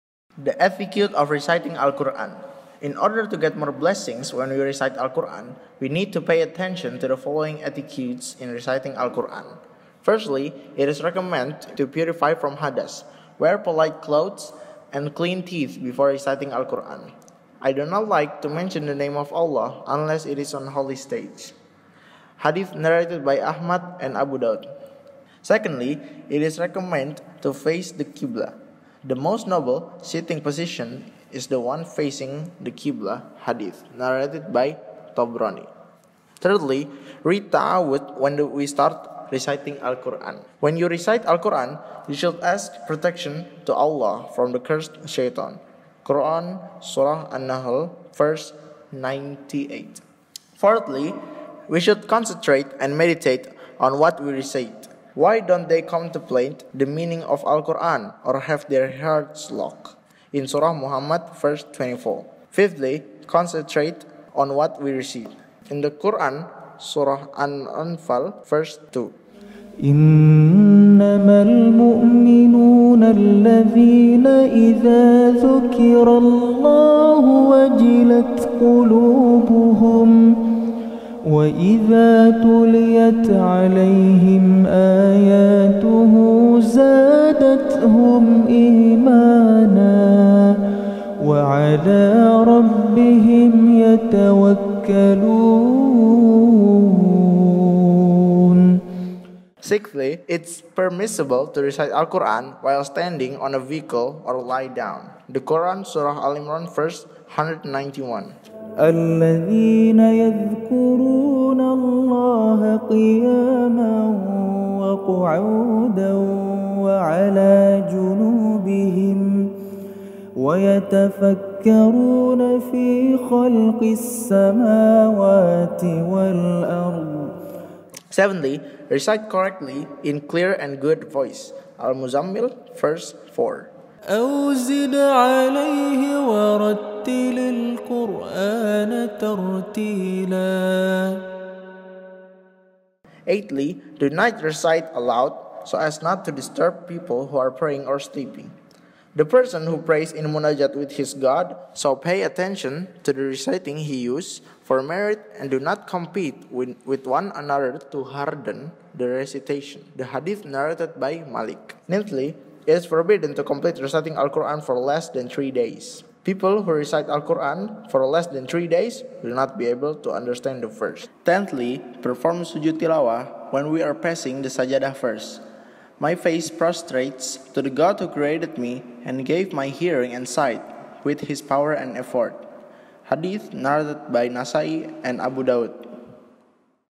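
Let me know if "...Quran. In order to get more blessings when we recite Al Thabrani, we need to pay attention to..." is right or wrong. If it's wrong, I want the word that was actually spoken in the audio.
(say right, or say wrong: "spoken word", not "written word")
wrong: "Quran", not "Thabrani".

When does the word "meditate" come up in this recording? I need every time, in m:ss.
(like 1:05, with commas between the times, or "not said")
0:53.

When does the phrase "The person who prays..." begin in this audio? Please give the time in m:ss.
2:29.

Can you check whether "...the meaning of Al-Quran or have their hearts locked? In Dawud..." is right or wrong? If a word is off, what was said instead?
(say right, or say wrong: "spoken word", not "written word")
wrong: "Surah", not "Dawud".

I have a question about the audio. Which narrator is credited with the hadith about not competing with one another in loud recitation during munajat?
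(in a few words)
Malik.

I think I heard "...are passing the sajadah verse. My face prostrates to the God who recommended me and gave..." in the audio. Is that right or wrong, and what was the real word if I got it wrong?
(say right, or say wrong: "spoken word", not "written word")
wrong: "created", not "recommended".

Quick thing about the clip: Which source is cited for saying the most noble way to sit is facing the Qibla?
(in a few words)
Thabrani.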